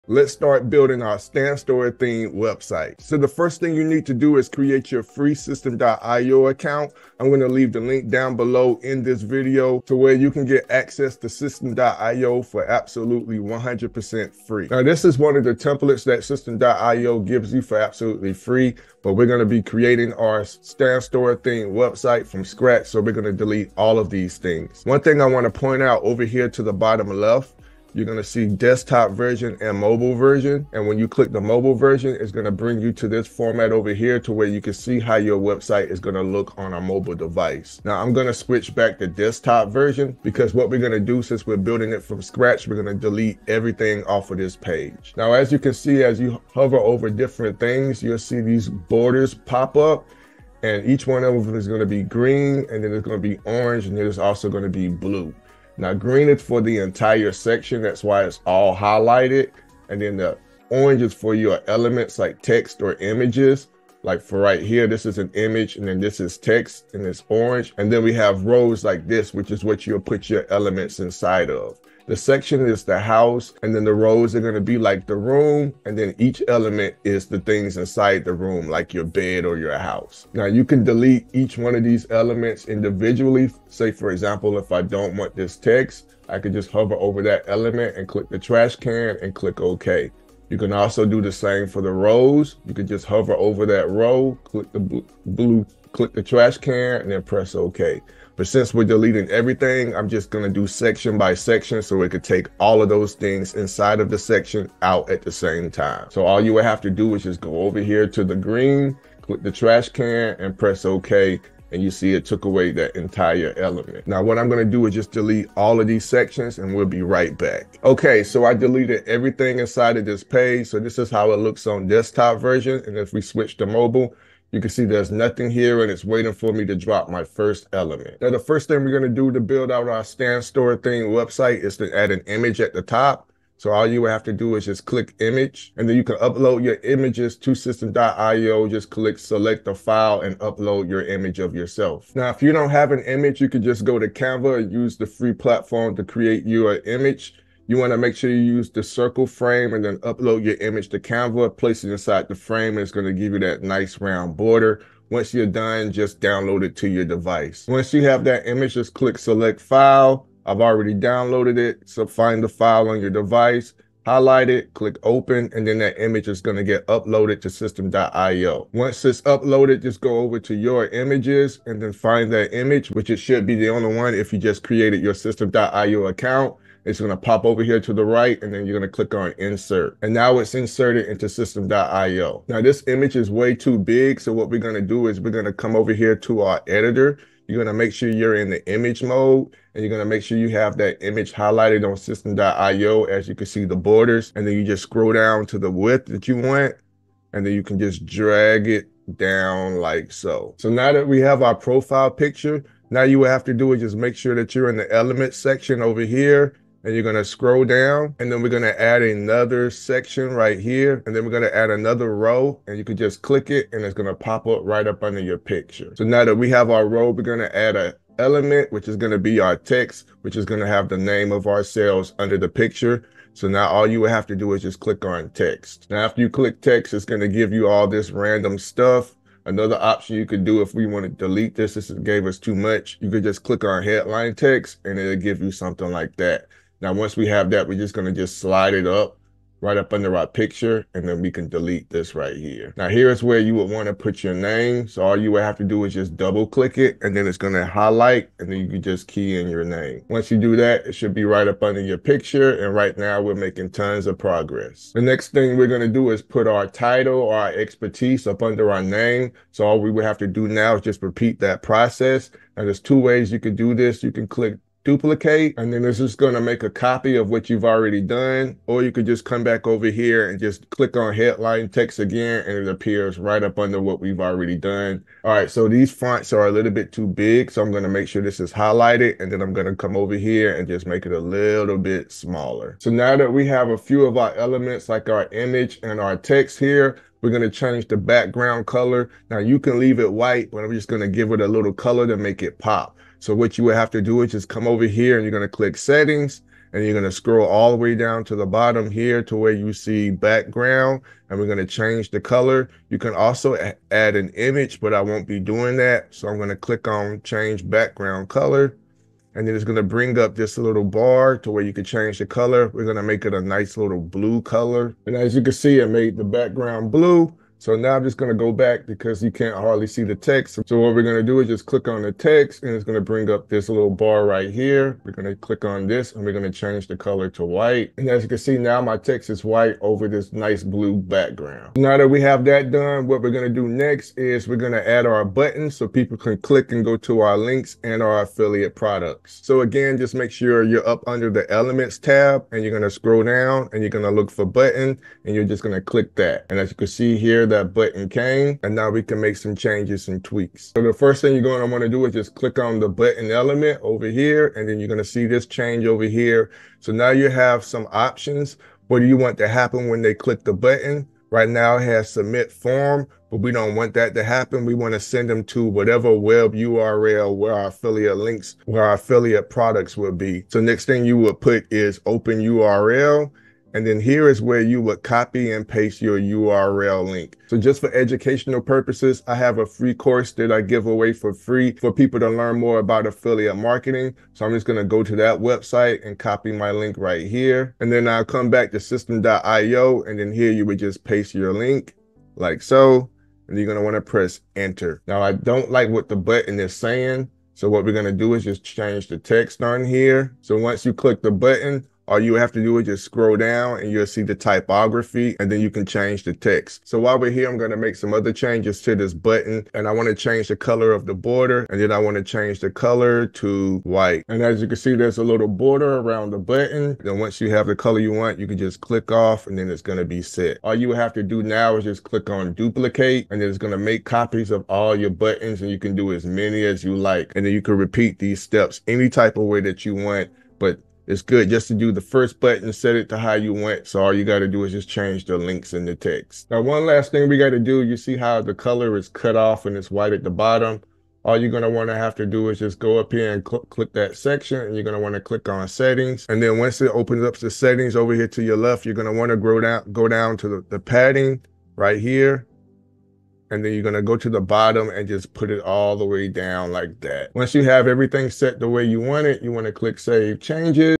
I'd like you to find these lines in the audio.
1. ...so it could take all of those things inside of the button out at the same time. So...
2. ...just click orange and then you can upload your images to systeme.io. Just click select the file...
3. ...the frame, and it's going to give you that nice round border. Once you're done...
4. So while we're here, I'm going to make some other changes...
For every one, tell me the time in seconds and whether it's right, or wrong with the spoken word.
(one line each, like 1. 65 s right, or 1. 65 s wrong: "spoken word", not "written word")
1. 101 s wrong: "section", not "button"
2. 134 s wrong: "image", not "orange"
3. 152 s right
4. 406 s right.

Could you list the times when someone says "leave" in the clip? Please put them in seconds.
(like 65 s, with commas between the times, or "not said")
7 s, 289 s.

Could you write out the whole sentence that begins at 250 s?
Once you do that, it should be right up under your picture, and right now we're making tons of progress.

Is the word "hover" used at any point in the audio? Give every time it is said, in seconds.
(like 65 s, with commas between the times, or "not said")
46 s, 86 s, 93 s.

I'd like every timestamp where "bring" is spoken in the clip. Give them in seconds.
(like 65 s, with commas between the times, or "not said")
32 s, 309 s, 323 s.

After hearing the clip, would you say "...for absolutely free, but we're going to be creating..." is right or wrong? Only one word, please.
right.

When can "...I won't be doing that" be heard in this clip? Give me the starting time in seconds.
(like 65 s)
304 s.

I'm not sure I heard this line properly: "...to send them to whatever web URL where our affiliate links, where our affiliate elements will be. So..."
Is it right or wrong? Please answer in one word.
wrong.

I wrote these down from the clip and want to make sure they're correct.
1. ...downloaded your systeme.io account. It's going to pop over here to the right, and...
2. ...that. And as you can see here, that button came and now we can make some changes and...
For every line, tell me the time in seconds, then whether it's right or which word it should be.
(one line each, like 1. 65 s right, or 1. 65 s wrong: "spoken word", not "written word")
1. 174 s wrong: "created", not "downloaded"
2. 346 s right.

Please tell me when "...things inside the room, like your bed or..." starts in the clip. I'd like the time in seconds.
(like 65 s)
77 s.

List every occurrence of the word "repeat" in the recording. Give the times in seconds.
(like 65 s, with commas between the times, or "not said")
261 s, 427 s.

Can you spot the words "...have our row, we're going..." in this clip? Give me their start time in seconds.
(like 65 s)
216 s.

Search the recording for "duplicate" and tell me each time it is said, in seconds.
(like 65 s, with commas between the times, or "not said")
264 s, 422 s.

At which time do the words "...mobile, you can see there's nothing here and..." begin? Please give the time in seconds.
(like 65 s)
123 s.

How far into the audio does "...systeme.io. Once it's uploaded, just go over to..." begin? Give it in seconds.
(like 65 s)
167 s.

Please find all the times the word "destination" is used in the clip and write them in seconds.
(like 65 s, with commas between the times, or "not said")
not said.